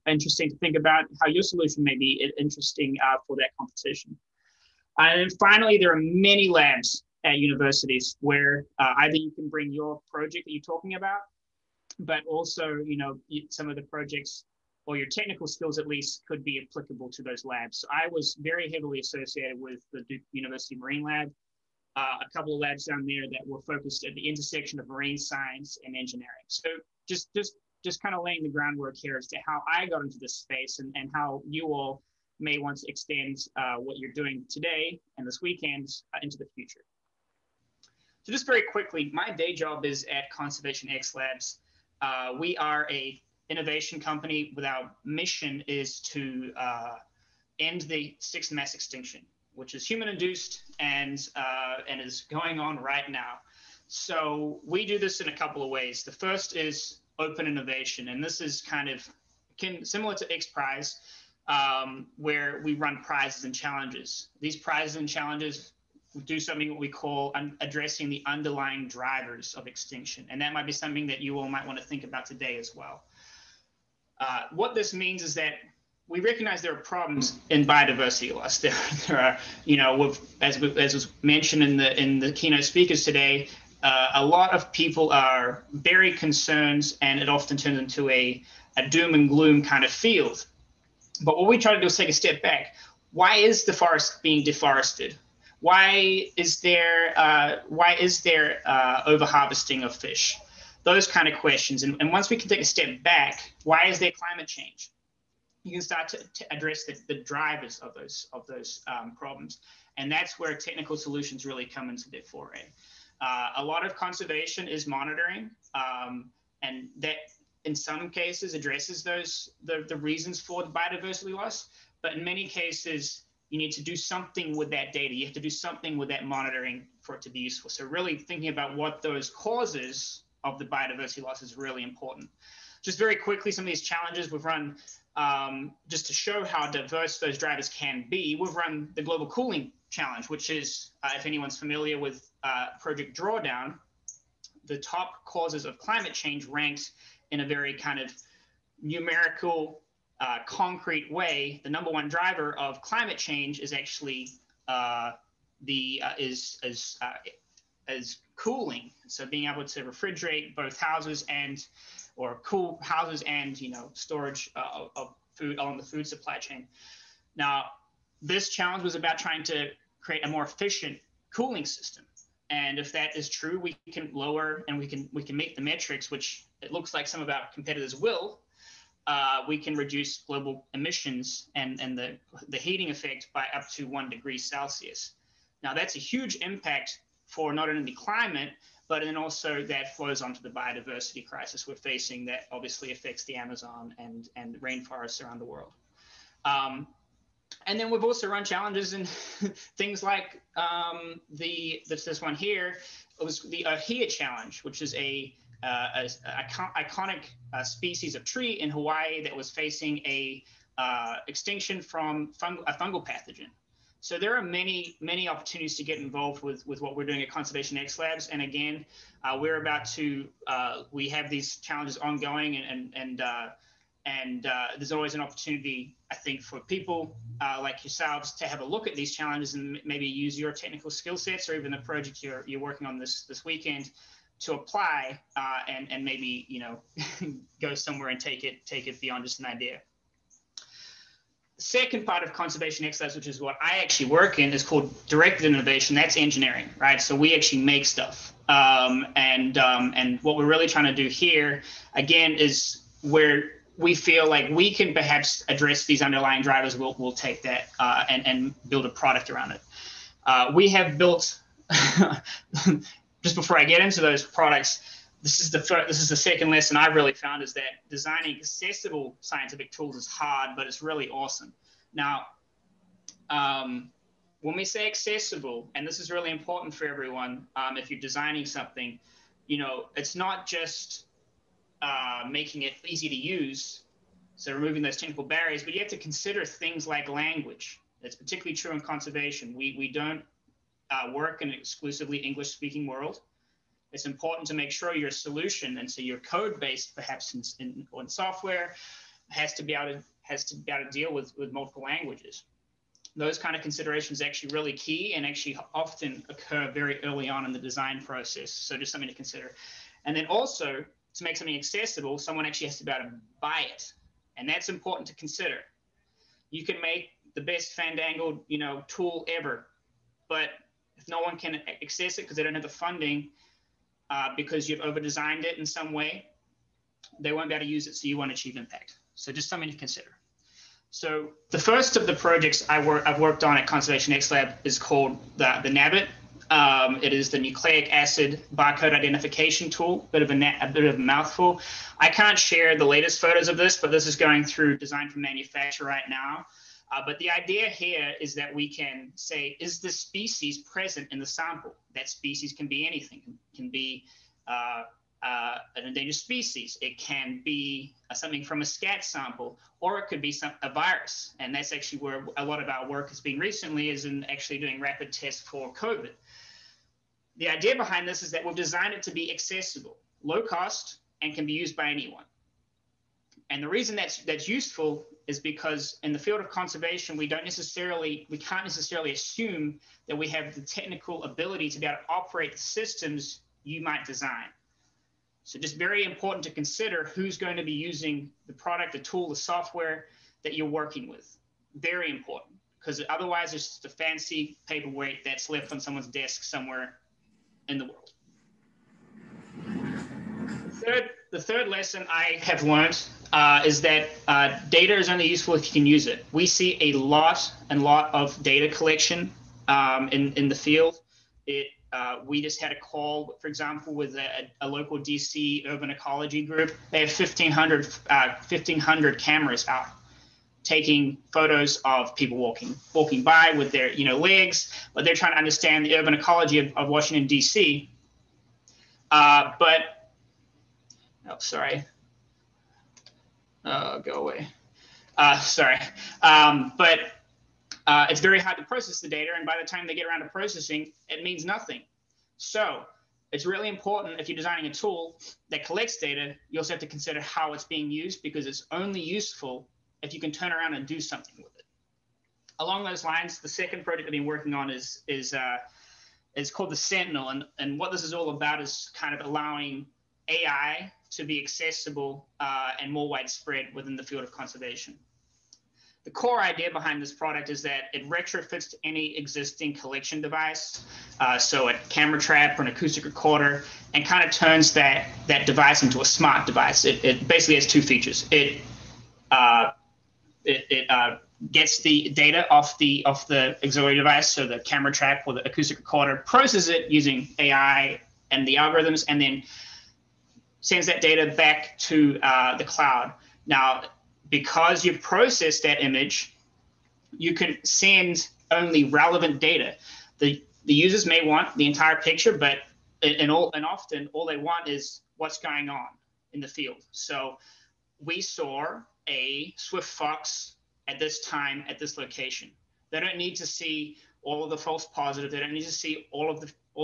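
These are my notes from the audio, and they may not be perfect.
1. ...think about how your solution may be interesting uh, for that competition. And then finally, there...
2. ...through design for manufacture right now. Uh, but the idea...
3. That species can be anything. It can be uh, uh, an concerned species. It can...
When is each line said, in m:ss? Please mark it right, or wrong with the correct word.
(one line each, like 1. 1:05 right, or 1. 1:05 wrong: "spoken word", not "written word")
1. 0:00 right
2. 5:44 right
3. 5:51 wrong: "endangered", not "concerned".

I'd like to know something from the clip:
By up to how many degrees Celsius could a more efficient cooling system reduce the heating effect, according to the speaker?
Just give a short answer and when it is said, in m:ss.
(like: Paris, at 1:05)
1 degree, at 3:03.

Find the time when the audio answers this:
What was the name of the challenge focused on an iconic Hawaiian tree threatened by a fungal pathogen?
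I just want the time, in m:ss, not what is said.
3:23.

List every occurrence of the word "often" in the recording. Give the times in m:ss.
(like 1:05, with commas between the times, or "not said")
1:27, 5:05, 8:23.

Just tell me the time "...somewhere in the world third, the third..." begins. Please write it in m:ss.
6:36.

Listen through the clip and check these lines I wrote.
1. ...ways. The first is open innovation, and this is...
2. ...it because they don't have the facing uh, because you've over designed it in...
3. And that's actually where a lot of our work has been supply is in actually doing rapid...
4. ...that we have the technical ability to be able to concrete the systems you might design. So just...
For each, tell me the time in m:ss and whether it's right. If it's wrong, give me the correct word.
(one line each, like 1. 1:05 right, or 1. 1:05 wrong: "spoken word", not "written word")
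1. 0:55 right
2. 5:22 wrong: "funding", not "facing"
3. 6:01 wrong: "recently", not "supply"
4. 6:20 wrong: "operate", not "concrete".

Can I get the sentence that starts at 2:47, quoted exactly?
Now, this challenge was about trying to create a more efficient cooling system.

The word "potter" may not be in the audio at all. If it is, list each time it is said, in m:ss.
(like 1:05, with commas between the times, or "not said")
not said.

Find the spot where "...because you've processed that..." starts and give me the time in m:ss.
8:14.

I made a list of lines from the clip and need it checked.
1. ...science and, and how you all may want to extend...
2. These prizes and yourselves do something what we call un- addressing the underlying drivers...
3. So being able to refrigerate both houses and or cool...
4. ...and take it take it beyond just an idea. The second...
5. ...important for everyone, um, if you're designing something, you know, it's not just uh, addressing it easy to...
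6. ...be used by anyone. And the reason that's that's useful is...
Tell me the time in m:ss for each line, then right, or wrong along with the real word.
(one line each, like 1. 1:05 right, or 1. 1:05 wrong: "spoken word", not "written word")
1. 0:30 wrong: "space", not "science"
2. 1:04 wrong: "challenges", not "yourselves"
3. 2:39 right
4. 3:58 right
5. 4:36 wrong: "making", not "addressing"
6. 6:11 right.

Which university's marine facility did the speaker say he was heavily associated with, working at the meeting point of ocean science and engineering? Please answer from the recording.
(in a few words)
Duke University.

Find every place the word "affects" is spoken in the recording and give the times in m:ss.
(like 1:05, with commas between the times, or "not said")
3:12.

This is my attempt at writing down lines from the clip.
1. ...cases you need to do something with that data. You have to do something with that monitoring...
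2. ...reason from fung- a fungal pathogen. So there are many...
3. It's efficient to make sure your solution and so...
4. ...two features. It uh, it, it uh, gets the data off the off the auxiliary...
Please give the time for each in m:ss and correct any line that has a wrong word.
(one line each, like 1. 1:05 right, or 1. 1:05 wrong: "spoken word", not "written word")
1. 2:02 right
2. 3:31 wrong: "extinction", not "reason"
3. 4:53 wrong: "important", not "efficient"
4. 7:57 right.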